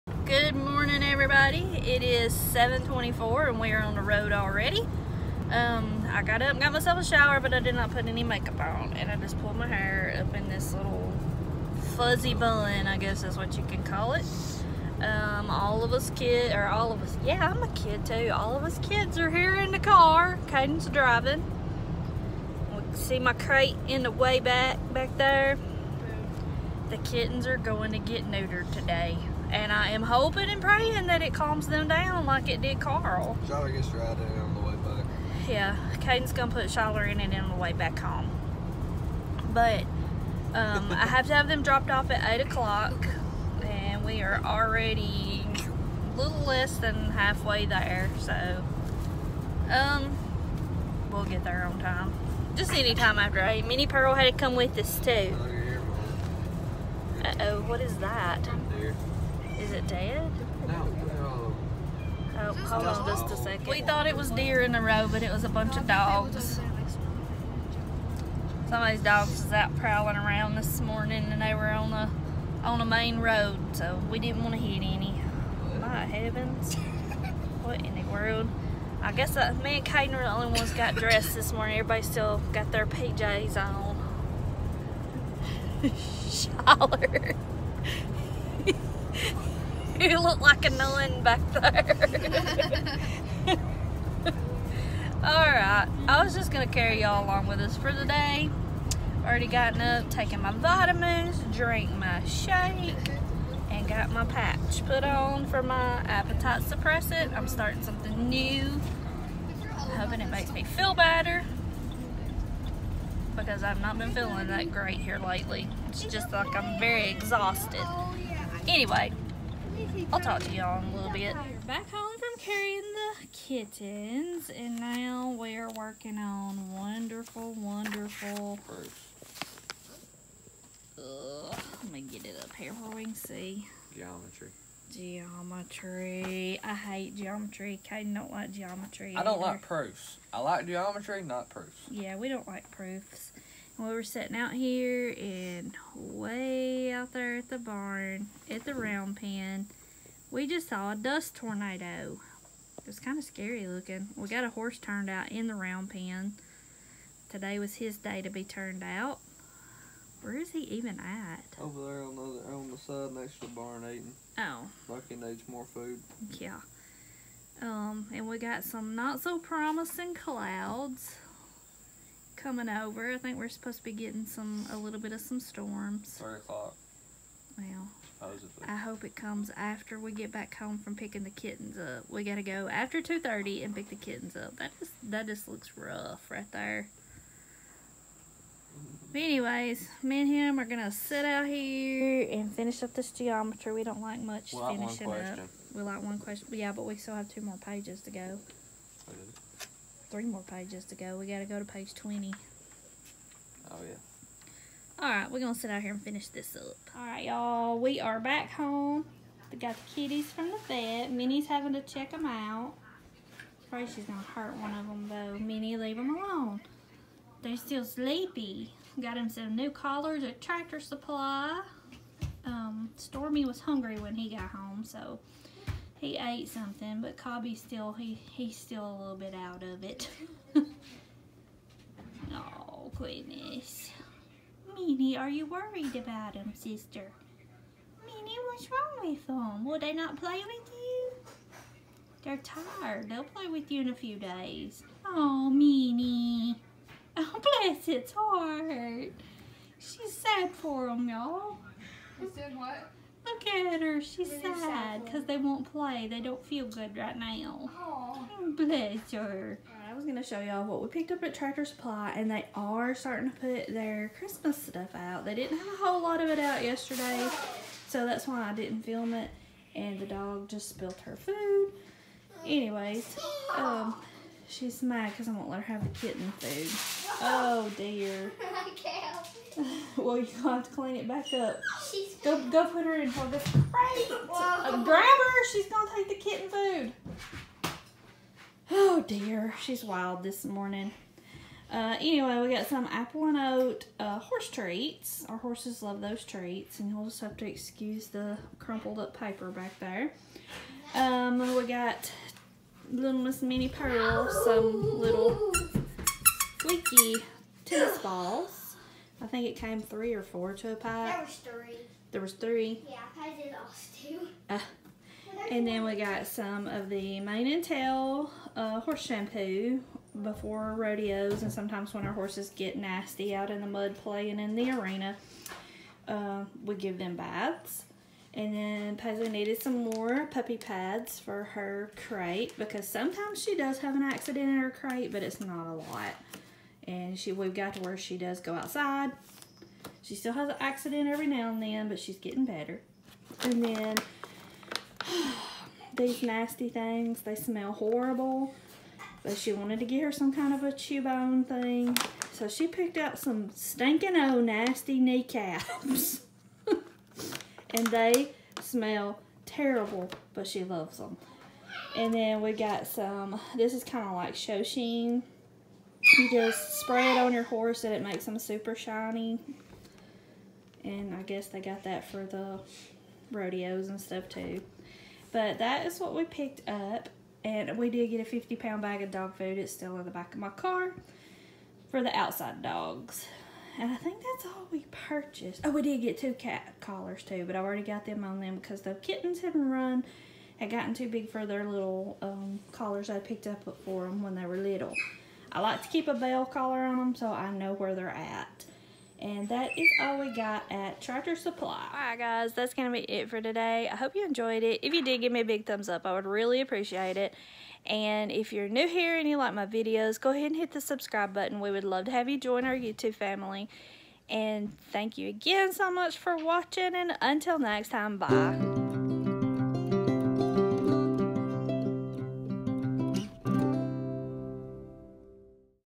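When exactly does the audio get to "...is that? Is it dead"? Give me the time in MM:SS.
00:57.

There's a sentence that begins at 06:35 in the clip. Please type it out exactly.
I like to keep a bell collar on them so I know where they're at.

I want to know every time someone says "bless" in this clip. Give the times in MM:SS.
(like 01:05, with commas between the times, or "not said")
04:07, 04:18.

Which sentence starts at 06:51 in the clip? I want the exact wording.
We would love to have you join our YouTube family.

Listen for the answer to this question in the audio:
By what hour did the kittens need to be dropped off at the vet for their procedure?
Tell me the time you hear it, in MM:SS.
00:42.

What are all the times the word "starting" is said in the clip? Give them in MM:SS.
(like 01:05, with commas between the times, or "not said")
01:47, 04:22.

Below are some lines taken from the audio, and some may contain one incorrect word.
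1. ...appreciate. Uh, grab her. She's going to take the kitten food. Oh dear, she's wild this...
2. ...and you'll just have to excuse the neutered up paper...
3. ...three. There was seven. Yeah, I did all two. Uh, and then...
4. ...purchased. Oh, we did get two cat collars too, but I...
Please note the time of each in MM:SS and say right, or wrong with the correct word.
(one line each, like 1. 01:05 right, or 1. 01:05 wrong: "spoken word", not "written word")
1. 04:43 wrong: "crate", not "appreciate"
2. 04:56 wrong: "crumpled", not "neutered"
3. 05:11 wrong: "three", not "seven"
4. 06:25 right.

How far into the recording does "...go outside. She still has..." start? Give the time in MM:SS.
05:38.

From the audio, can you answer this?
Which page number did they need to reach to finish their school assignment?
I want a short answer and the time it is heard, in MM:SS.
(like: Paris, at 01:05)
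Page 20, at 03:21.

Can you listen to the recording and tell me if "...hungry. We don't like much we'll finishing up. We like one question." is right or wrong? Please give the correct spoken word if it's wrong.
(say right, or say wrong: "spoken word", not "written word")
wrong: "geometry", not "hungry".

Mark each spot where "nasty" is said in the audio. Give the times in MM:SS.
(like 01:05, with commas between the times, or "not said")
05:22, 05:46, 05:54.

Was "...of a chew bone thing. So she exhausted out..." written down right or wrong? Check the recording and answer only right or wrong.
wrong.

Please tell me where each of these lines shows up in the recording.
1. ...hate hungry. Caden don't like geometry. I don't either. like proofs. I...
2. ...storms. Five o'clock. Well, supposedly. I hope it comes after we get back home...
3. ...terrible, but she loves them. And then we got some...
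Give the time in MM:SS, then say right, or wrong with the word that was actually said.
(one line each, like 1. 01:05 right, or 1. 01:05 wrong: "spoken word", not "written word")
1. 02:16 wrong: "geometry", not "hungry"
2. 02:55 wrong: "Three", not "Five"
3. 05:59 right.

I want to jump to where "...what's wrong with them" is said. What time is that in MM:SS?
03:58.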